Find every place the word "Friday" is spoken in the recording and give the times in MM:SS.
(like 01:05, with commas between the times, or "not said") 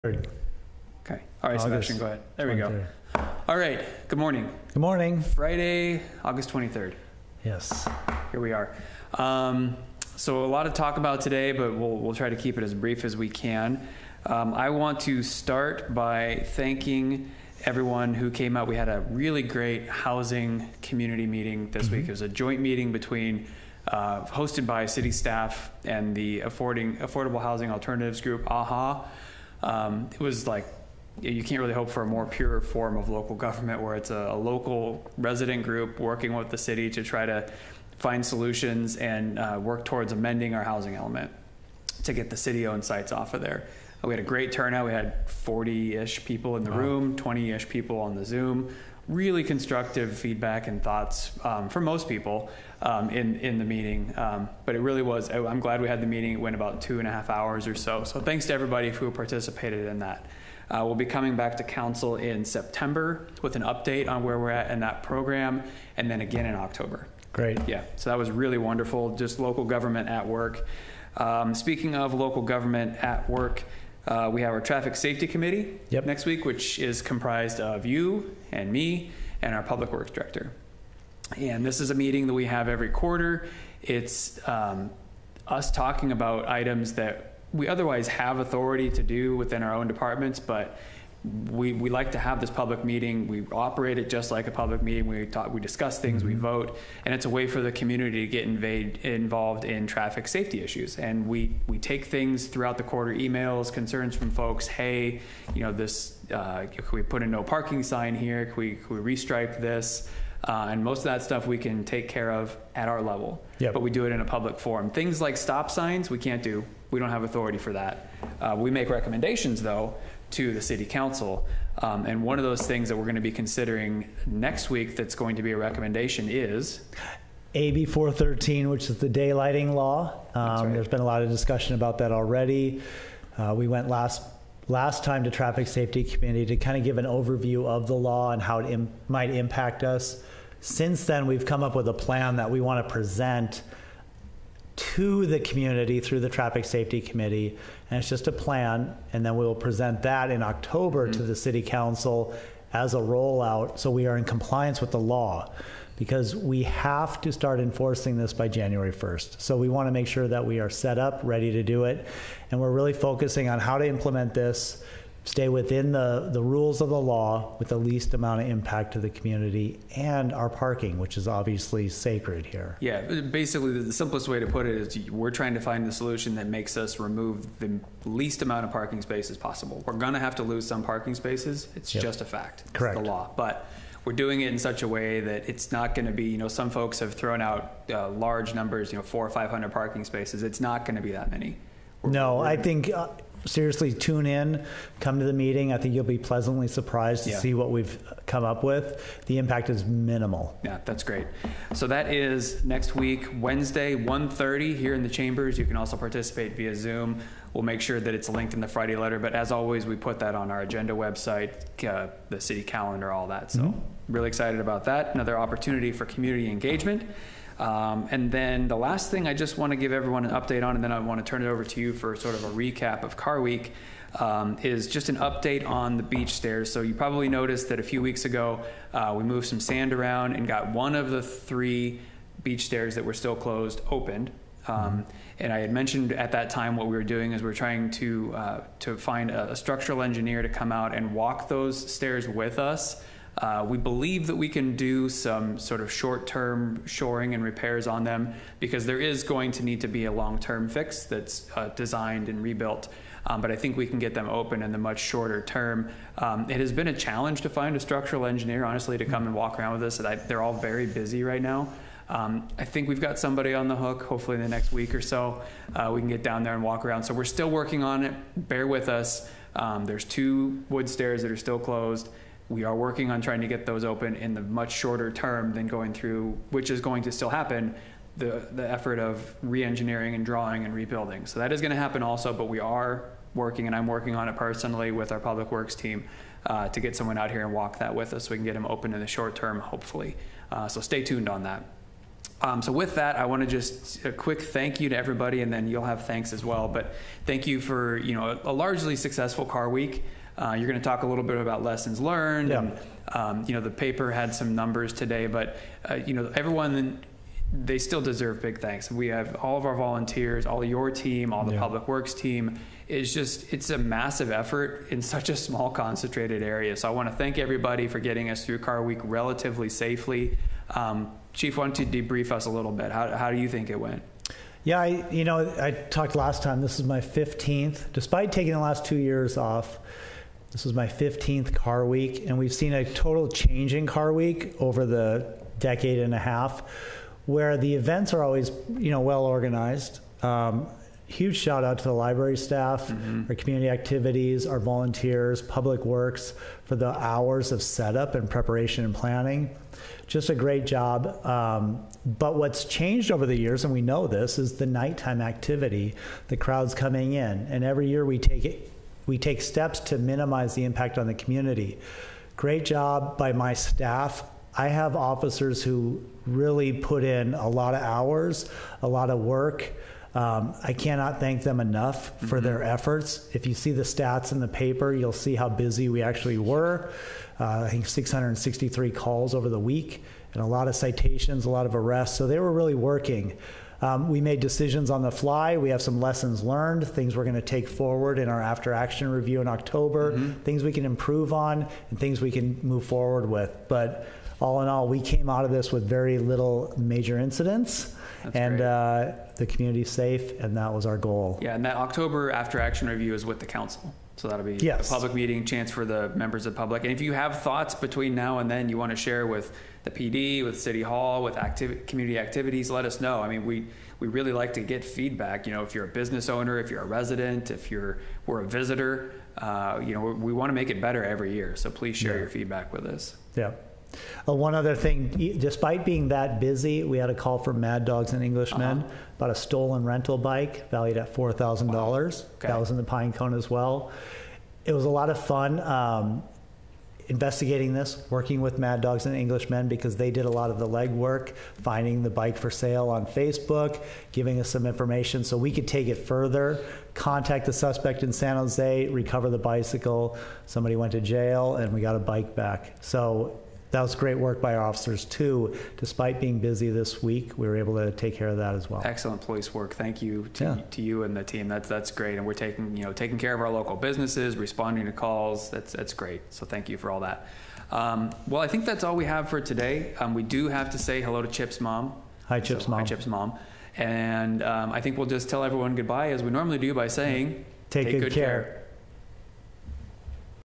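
00:05, 03:28.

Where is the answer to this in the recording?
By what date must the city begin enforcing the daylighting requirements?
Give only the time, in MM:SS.
02:38.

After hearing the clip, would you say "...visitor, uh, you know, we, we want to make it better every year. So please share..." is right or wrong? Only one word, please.
right.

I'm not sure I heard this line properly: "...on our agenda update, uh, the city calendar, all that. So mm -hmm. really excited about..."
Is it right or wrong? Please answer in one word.
wrong.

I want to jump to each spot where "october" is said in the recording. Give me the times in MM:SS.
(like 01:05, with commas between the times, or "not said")
01:06, 02:30, 06:29, 06:41.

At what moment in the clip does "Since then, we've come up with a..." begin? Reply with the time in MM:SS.
02:20.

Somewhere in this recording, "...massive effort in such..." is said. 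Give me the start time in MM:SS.
05:13.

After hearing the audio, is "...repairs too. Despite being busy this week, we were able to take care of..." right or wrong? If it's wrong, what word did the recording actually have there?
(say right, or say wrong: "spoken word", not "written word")
wrong: "officers", not "repairs".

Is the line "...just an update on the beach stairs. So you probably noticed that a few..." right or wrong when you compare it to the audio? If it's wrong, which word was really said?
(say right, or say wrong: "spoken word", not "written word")
right.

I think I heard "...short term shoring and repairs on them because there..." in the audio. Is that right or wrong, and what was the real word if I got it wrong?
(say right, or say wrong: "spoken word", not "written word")
right.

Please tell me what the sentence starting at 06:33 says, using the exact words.
But all in all, we came out of this with very little major incidents.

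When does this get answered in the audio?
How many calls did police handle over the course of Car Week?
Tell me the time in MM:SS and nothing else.
06:17.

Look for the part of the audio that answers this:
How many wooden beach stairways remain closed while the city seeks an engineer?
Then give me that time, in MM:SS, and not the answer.
04:30.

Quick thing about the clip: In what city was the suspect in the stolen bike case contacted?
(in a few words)
San Jose.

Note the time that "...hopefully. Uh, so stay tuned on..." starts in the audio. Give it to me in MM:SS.
04:49.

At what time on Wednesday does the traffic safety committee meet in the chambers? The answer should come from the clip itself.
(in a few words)
1:30.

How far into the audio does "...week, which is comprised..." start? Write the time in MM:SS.
01:16.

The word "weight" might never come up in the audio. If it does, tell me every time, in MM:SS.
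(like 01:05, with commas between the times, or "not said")
not said.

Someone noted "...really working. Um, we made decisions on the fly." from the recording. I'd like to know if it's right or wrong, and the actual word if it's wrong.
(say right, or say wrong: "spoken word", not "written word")
right.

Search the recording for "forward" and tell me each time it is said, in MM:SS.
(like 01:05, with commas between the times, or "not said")
06:27, 06:32.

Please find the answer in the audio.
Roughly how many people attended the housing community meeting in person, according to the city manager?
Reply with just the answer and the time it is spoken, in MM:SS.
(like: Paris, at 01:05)
40, at 00:45.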